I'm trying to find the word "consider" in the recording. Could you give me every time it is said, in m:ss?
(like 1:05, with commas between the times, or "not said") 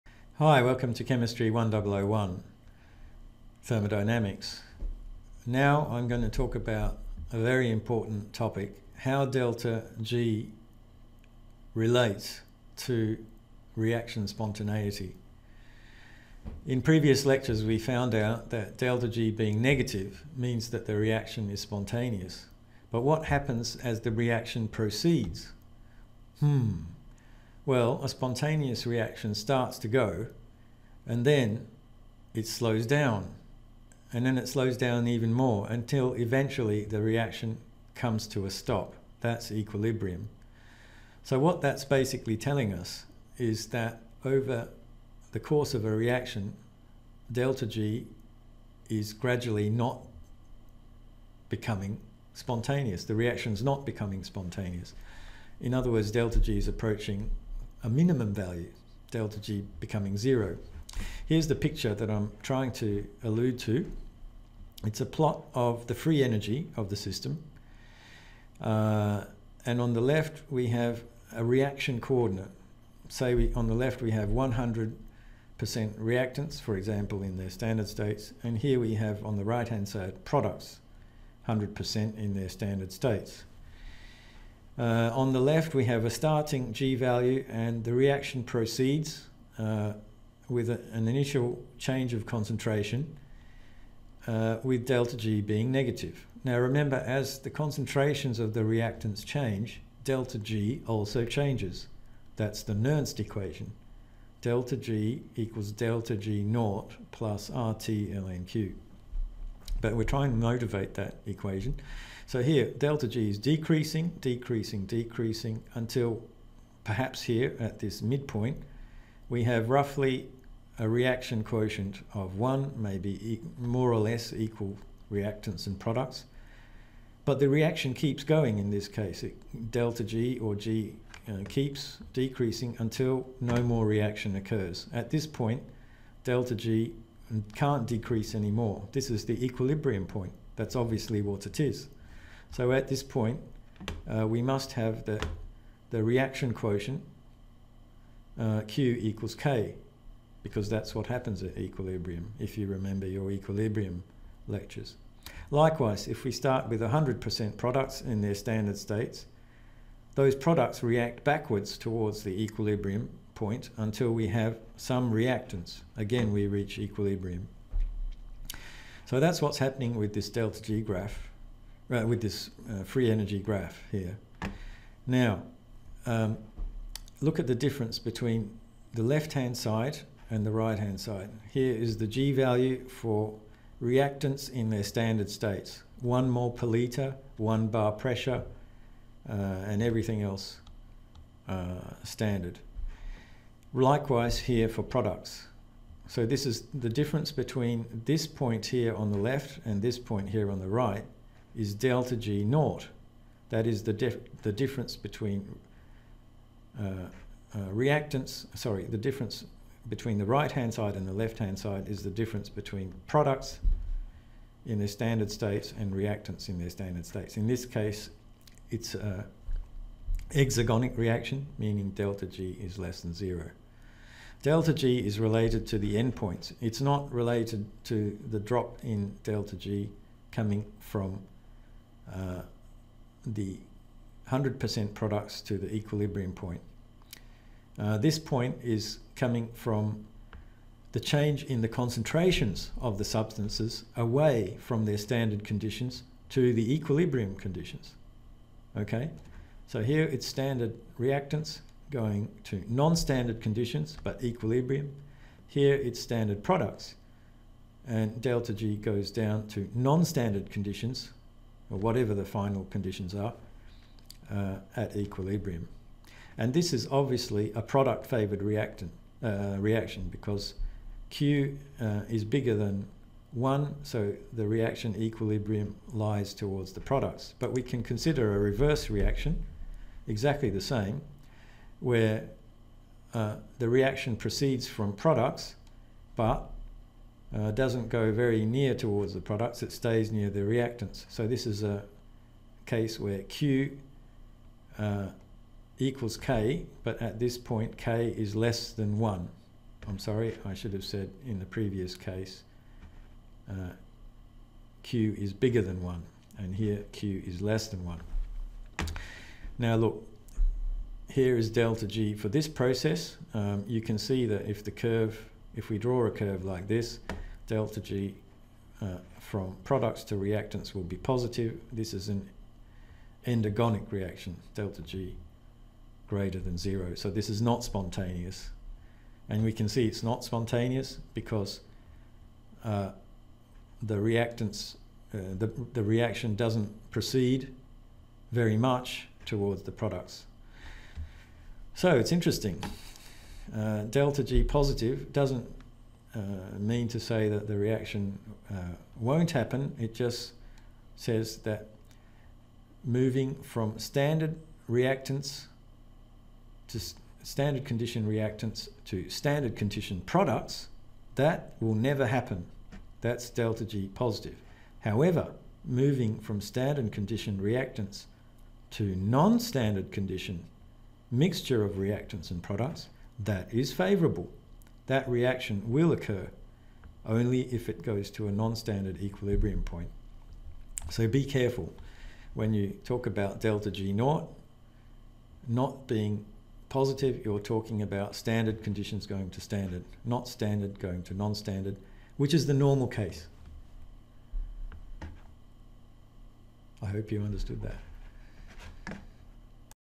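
4:37.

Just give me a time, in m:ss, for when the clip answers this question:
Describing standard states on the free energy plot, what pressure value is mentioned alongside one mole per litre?
3:07.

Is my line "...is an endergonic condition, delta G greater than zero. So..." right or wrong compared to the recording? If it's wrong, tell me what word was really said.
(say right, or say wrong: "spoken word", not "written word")
wrong: "reaction", not "condition".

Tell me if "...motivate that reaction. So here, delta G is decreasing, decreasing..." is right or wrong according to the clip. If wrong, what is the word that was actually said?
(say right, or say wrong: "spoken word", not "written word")
wrong: "equation", not "reaction".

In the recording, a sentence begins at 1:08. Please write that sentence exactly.
Uh, and on the left, we have a reaction coordinate.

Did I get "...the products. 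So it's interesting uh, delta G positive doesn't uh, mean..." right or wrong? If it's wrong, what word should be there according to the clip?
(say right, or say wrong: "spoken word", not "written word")
right.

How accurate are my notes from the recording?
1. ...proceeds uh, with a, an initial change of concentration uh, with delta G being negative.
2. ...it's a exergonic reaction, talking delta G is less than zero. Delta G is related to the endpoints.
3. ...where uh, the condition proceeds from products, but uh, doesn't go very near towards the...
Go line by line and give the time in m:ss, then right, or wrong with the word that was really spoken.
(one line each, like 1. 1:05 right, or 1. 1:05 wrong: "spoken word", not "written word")
1. 1:28 right
2. 3:38 wrong: "meaning", not "talking"
3. 4:41 wrong: "reaction", not "condition".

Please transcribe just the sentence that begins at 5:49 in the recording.
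It just says that moving from standard reactants to standard condition reactants to standard condition products, that will never happen.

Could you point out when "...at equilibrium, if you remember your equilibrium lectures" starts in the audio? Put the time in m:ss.
2:31.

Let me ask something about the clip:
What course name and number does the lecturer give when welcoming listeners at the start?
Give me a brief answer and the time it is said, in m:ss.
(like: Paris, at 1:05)
Chemistry 1001, at 0:01.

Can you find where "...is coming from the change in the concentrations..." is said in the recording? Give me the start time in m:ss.
3:58.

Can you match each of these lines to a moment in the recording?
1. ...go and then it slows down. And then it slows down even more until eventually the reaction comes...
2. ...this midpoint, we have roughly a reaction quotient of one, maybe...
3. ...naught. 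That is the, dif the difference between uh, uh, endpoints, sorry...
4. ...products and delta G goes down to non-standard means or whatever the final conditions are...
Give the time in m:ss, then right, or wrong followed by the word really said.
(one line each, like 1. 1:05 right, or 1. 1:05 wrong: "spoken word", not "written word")
1. 0:29 right
2. 1:57 right
3. 3:22 wrong: "reactants", not "endpoints"
4. 4:16 wrong: "conditions", not "means".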